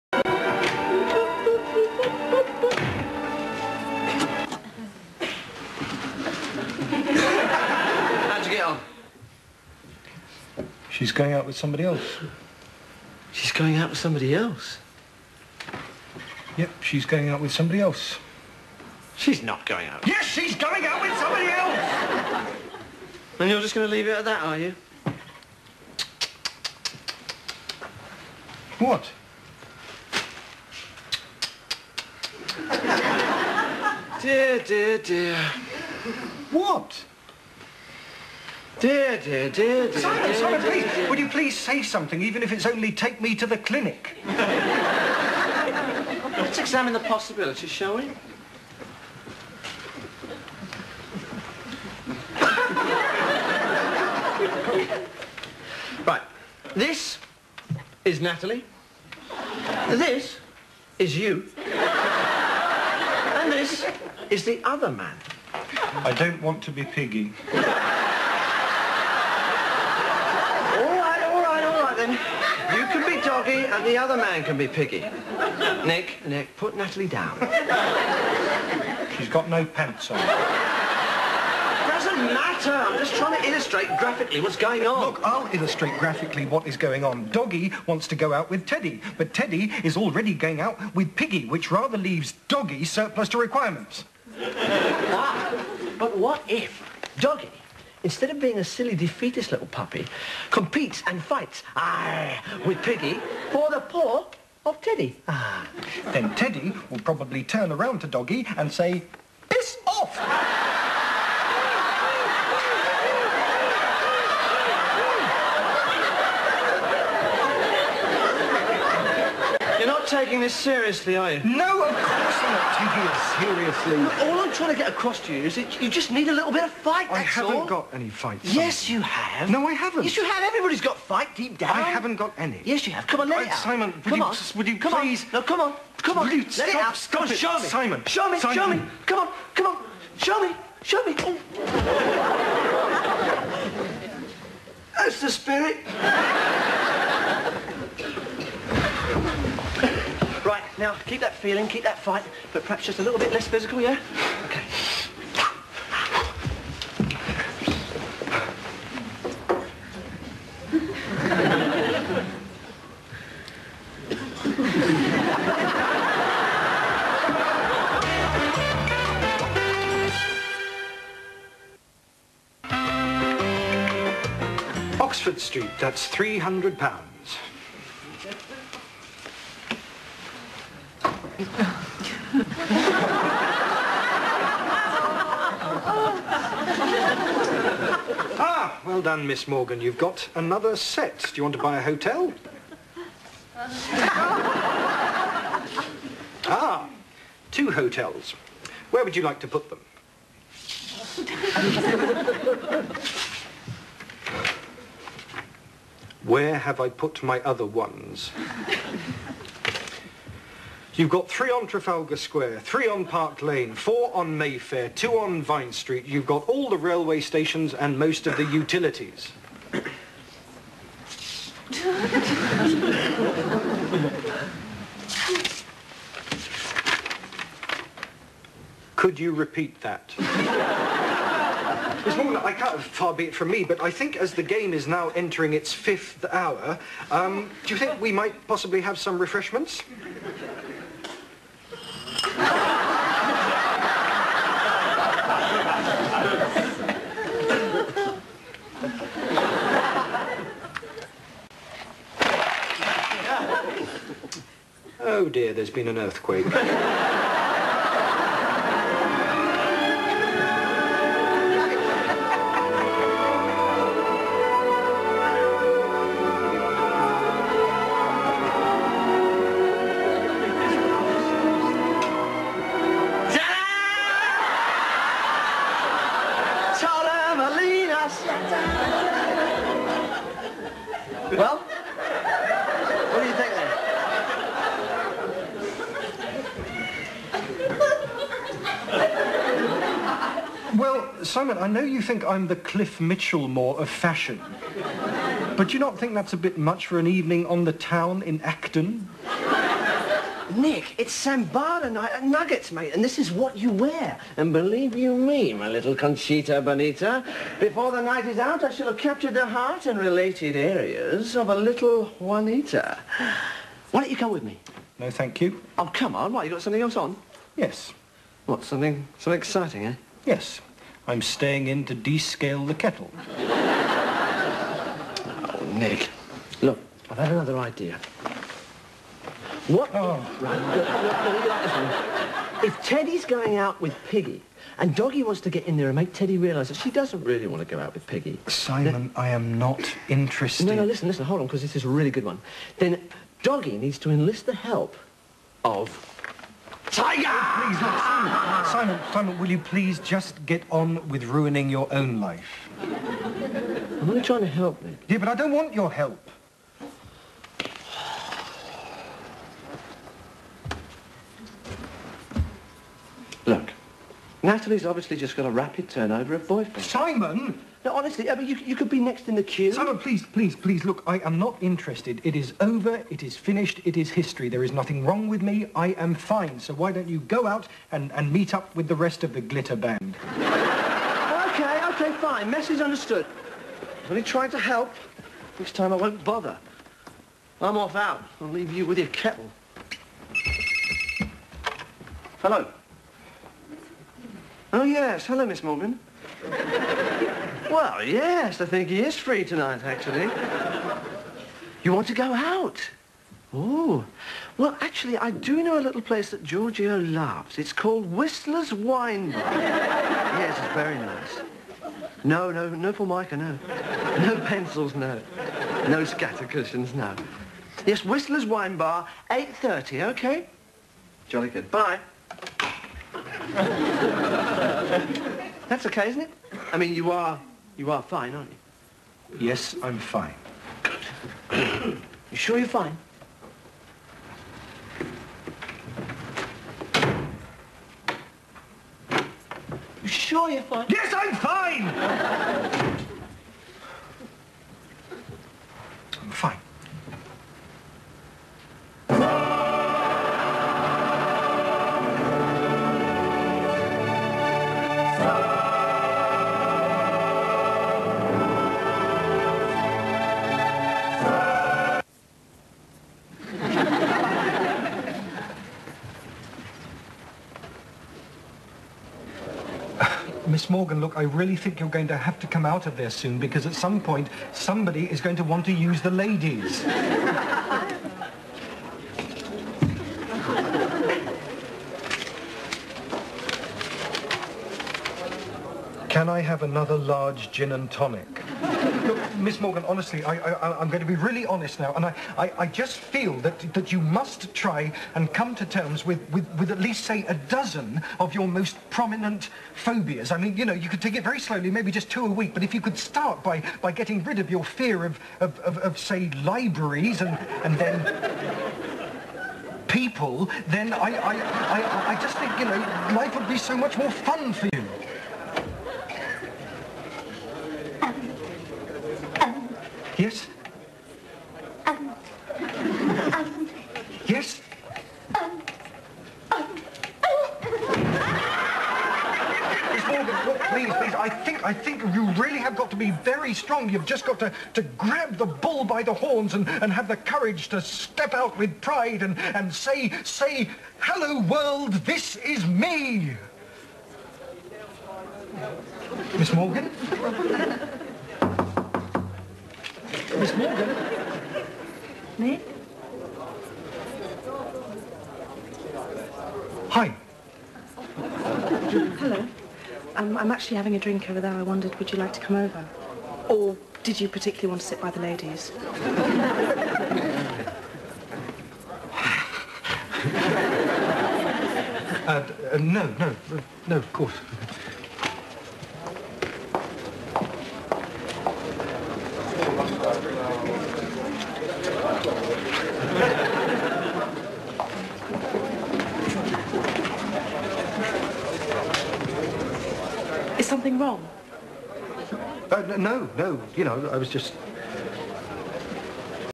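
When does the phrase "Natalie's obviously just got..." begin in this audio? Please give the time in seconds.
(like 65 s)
364 s.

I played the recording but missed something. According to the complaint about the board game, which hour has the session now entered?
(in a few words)
Fifth.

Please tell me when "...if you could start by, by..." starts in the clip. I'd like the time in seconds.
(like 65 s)
502 s.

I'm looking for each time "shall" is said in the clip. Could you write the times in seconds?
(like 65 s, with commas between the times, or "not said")
47 s, 308 s.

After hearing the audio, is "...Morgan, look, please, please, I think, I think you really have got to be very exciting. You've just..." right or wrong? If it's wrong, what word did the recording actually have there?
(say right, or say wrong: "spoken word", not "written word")
wrong: "strong", not "exciting".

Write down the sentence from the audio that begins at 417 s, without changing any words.
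Yes, Whistler's Wine Bar, 8.30, OK?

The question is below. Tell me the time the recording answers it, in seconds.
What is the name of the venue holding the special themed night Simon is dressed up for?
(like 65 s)
302 s.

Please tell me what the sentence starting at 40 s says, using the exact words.
Simon, dear, Simon, dear, please, dear, would you please say something, even if it's only take me to the clinic?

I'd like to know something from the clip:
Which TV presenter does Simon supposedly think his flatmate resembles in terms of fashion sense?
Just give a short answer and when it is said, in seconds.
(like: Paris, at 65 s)
Cliff Michelmore, at 292 s.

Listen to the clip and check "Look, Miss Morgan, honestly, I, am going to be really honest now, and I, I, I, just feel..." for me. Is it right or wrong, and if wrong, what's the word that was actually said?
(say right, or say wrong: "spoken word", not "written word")
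right.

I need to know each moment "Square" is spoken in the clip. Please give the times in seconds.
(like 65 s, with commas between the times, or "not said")
212 s.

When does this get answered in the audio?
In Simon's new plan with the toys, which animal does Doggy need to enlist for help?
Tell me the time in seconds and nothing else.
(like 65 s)
346 s.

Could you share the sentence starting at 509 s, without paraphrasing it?
people, then I, I, I, I just think, you know, life would be so much more fun for you.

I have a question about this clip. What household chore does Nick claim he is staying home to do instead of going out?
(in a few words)
Descale the kettle.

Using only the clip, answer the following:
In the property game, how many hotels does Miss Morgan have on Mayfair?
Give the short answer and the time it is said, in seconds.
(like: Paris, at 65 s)
4, at 213 s.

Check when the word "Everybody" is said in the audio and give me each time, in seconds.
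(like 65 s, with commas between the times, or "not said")
130 s.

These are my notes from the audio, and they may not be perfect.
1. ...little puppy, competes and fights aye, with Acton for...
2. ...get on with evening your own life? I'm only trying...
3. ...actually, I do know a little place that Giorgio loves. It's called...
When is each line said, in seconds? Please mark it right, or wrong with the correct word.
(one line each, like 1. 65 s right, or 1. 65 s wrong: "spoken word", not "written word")
1. 99 s wrong: "Piggy", not "Acton"
2. 350 s wrong: "ruining", not "evening"
3. 404 s right.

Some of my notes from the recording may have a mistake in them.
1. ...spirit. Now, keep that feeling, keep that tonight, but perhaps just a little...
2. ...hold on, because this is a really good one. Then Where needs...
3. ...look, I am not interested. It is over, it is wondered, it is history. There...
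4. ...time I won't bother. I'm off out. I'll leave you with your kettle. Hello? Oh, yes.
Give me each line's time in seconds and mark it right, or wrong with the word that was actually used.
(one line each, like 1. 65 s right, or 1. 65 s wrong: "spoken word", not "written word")
1. 145 s wrong: "fight", not "tonight"
2. 341 s wrong: "Doggy", not "Where"
3. 370 s wrong: "finished", not "wondered"
4. 385 s right.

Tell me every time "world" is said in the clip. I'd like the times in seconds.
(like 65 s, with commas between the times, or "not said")
541 s.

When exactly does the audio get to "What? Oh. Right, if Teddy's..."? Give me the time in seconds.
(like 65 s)
329 s.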